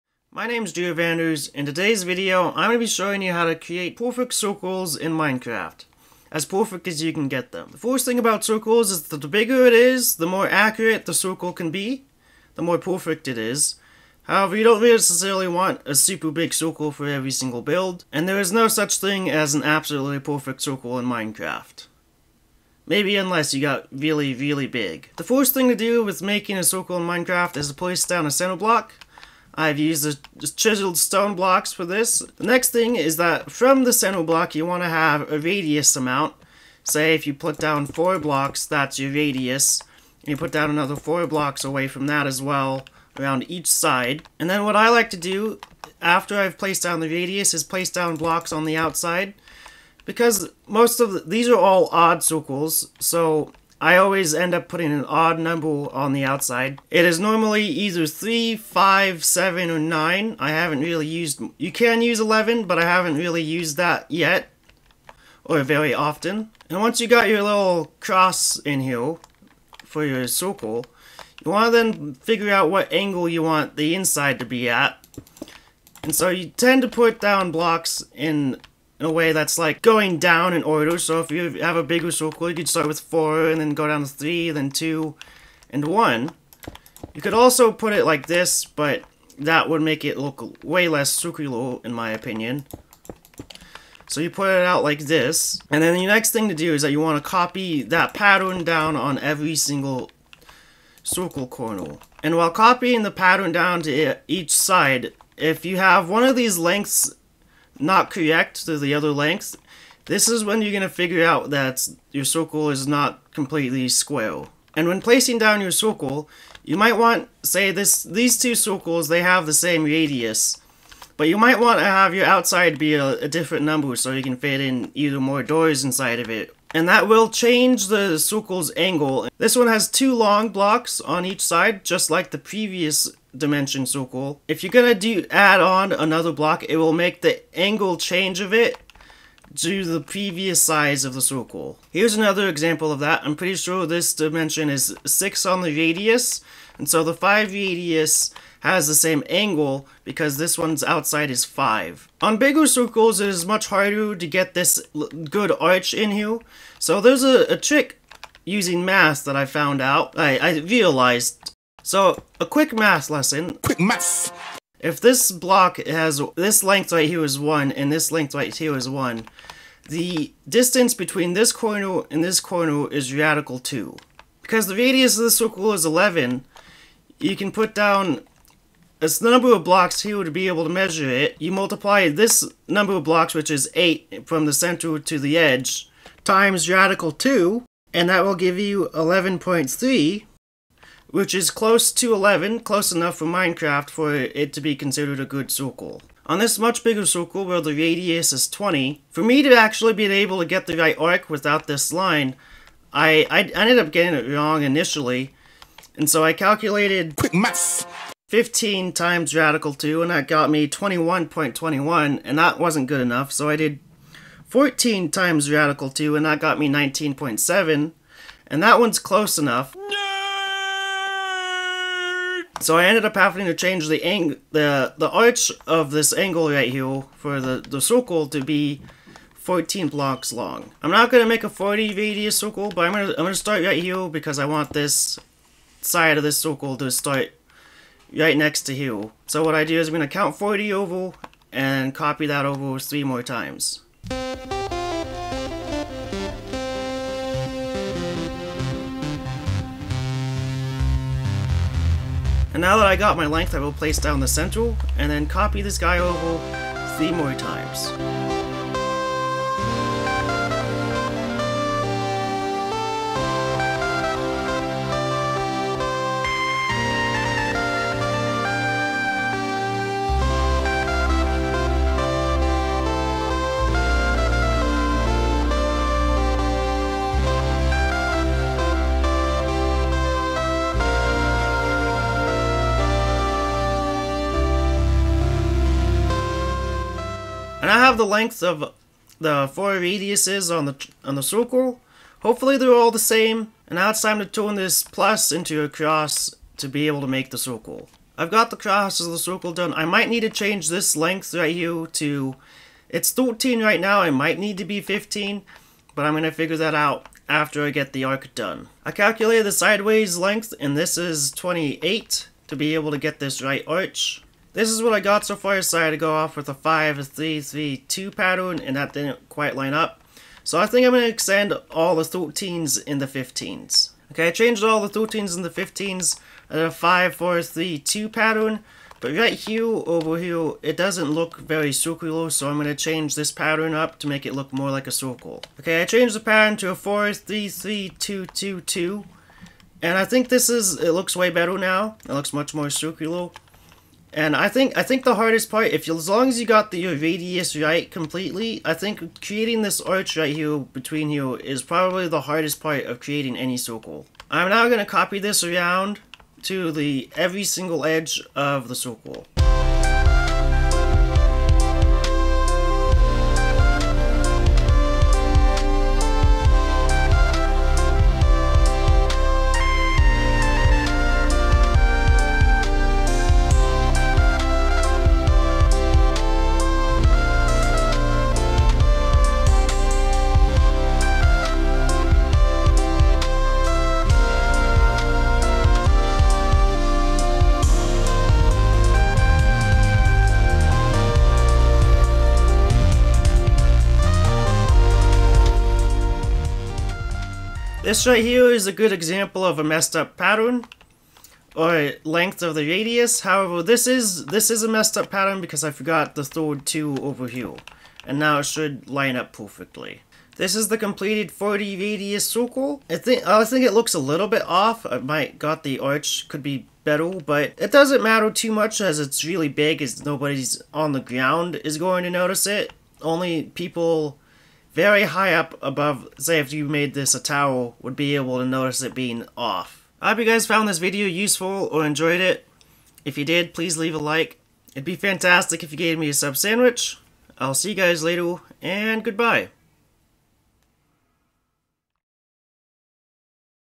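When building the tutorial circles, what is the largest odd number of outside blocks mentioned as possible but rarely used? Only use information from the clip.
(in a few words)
11.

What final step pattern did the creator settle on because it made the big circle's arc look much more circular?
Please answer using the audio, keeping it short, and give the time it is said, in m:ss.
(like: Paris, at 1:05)
4-3-3-2-2-2, at 5:36.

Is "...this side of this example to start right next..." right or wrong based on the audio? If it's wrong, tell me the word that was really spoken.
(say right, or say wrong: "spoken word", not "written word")
wrong: "circle", not "example".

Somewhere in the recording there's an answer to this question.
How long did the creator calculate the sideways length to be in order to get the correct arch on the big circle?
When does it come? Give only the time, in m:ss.
5:10.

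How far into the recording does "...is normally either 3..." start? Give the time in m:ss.
0:57.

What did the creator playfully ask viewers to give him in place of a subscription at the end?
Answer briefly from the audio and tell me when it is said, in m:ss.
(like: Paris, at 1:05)
A sub sandwich, at 7:16.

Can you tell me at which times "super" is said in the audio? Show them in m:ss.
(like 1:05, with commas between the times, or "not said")
0:15.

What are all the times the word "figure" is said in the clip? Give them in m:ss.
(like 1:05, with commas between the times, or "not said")
1:12, 1:50, 5:06.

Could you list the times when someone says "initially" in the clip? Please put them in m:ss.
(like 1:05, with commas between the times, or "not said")
3:24.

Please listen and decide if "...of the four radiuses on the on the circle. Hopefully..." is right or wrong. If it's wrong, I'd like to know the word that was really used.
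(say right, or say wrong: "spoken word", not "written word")
right.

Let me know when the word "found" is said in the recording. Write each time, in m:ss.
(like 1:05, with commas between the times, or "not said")
2:39, 7:10.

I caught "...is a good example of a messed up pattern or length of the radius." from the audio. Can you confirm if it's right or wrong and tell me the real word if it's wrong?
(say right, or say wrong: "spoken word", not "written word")
right.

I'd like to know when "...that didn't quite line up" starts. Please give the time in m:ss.
5:18.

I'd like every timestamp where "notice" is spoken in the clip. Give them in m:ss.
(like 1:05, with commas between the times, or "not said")
7:02, 7:08.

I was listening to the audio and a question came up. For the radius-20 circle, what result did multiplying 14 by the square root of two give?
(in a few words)
19.7.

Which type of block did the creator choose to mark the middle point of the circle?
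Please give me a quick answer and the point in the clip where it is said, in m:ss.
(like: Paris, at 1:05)
Chiseled stone, at 0:30.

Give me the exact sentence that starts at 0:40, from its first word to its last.
And you put down another four blocks away from that as well, around each side.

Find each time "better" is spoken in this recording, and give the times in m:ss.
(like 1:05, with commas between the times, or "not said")
5:41, 6:56.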